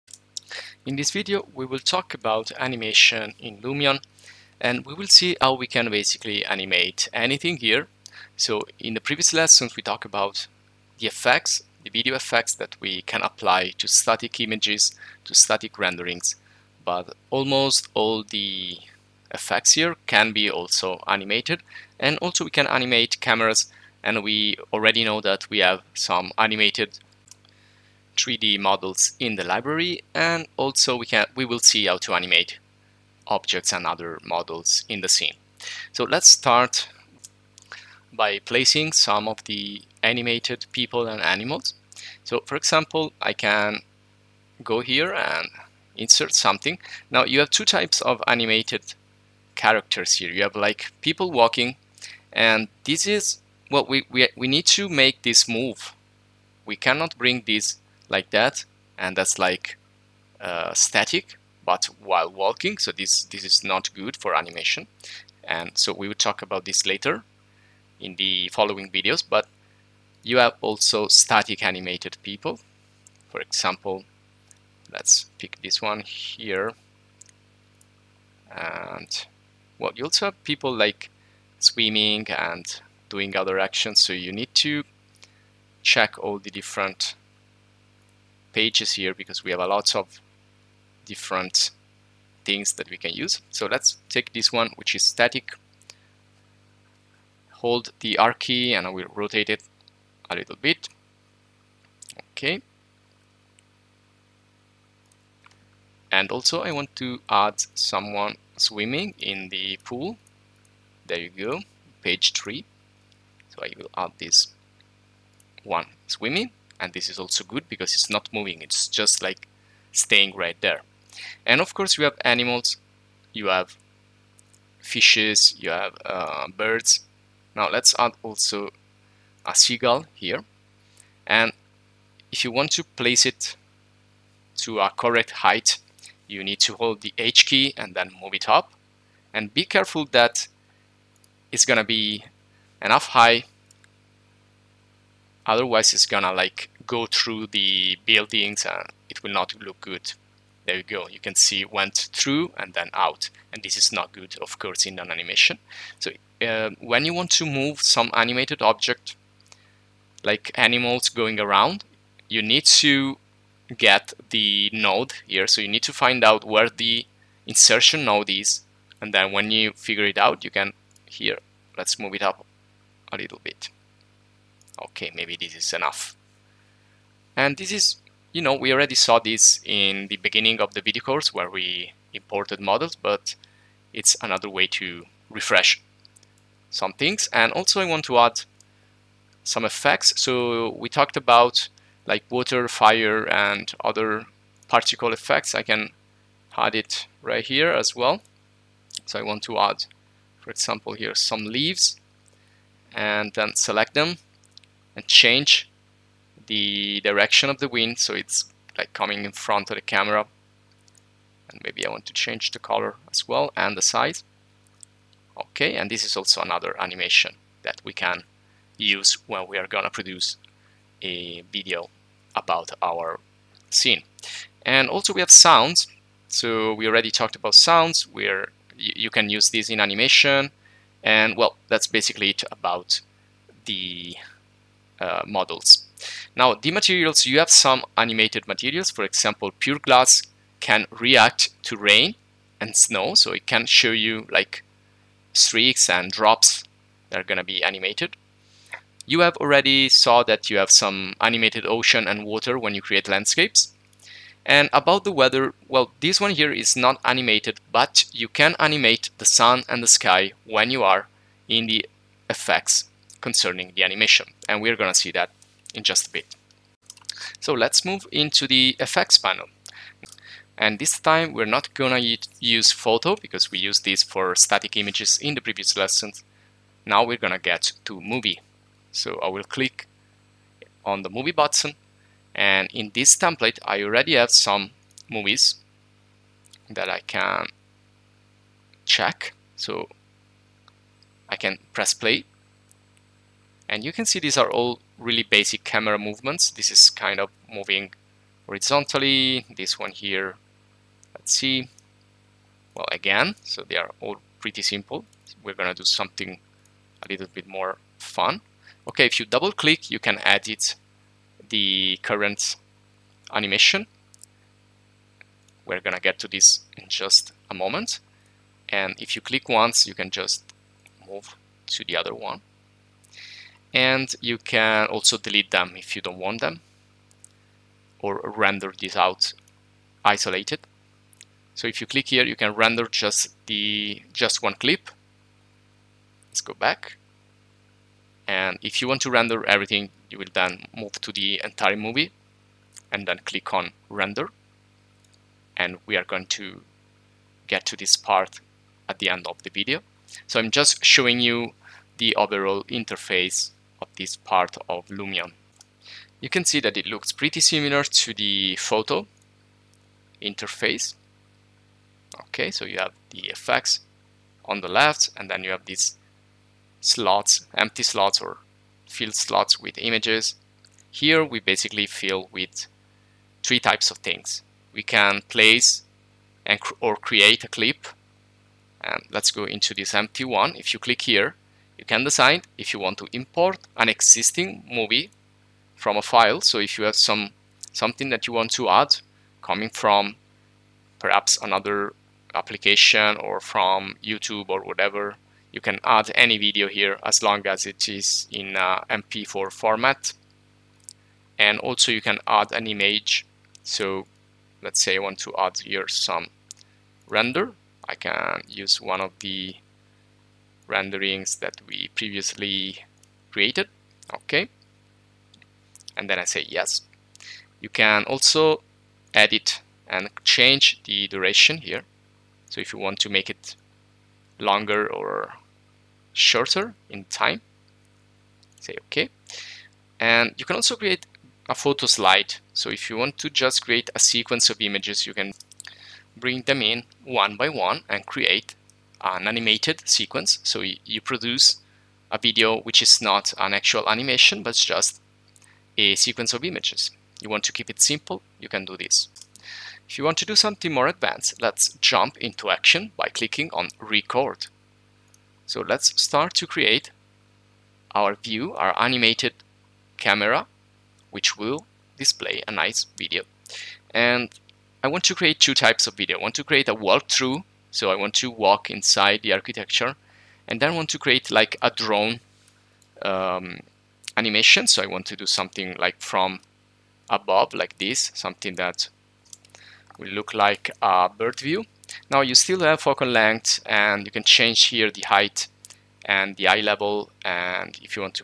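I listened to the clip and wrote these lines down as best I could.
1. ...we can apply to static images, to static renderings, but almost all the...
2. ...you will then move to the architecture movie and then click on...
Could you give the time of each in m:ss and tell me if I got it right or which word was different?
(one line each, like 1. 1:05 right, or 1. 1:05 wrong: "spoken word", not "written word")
1. 0:12 right
2. 5:40 wrong: "entire", not "architecture".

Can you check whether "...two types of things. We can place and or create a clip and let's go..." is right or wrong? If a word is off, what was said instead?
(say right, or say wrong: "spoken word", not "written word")
wrong: "three", not "two".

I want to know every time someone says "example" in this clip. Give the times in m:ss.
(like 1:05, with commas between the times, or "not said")
0:42, 1:13, 3:20, 3:59.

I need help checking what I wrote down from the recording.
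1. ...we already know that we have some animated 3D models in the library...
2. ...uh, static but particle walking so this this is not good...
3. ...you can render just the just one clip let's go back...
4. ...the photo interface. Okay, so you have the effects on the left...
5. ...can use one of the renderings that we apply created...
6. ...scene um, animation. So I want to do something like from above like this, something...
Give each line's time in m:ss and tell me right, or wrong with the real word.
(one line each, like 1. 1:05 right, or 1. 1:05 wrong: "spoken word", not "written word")
1. 0:24 right
2. 1:00 wrong: "while", not "particle"
3. 5:32 right
4. 5:58 right
5. 6:47 wrong: "previously", not "apply"
6. 7:51 wrong: "drone", not "scene".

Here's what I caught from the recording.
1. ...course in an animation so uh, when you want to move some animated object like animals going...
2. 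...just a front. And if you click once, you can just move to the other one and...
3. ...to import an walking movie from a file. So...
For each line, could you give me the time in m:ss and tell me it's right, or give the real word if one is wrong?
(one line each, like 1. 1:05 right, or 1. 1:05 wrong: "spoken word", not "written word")
1. 2:34 right
2. 5:16 wrong: "moment", not "front"
3. 6:22 wrong: "existing", not "walking".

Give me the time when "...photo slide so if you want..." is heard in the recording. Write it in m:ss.
7:11.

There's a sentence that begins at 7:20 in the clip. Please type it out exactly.
So you produce a video which is not an actual animation, but just a sequence of images.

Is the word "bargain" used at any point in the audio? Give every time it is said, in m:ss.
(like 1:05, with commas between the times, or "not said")
not said.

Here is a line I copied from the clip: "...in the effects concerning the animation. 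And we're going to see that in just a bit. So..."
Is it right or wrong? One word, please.
right.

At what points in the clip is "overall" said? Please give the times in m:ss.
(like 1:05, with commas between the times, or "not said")
5:52.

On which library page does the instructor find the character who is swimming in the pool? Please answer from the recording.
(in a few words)
Page 3.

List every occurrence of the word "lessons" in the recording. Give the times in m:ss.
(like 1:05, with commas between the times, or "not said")
0:09, 4:35.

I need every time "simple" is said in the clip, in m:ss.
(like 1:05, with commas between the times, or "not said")
5:04, 7:27.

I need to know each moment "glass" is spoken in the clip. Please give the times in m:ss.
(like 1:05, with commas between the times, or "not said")
3:59.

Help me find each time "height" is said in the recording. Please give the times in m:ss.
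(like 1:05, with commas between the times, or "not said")
2:15, 8:05.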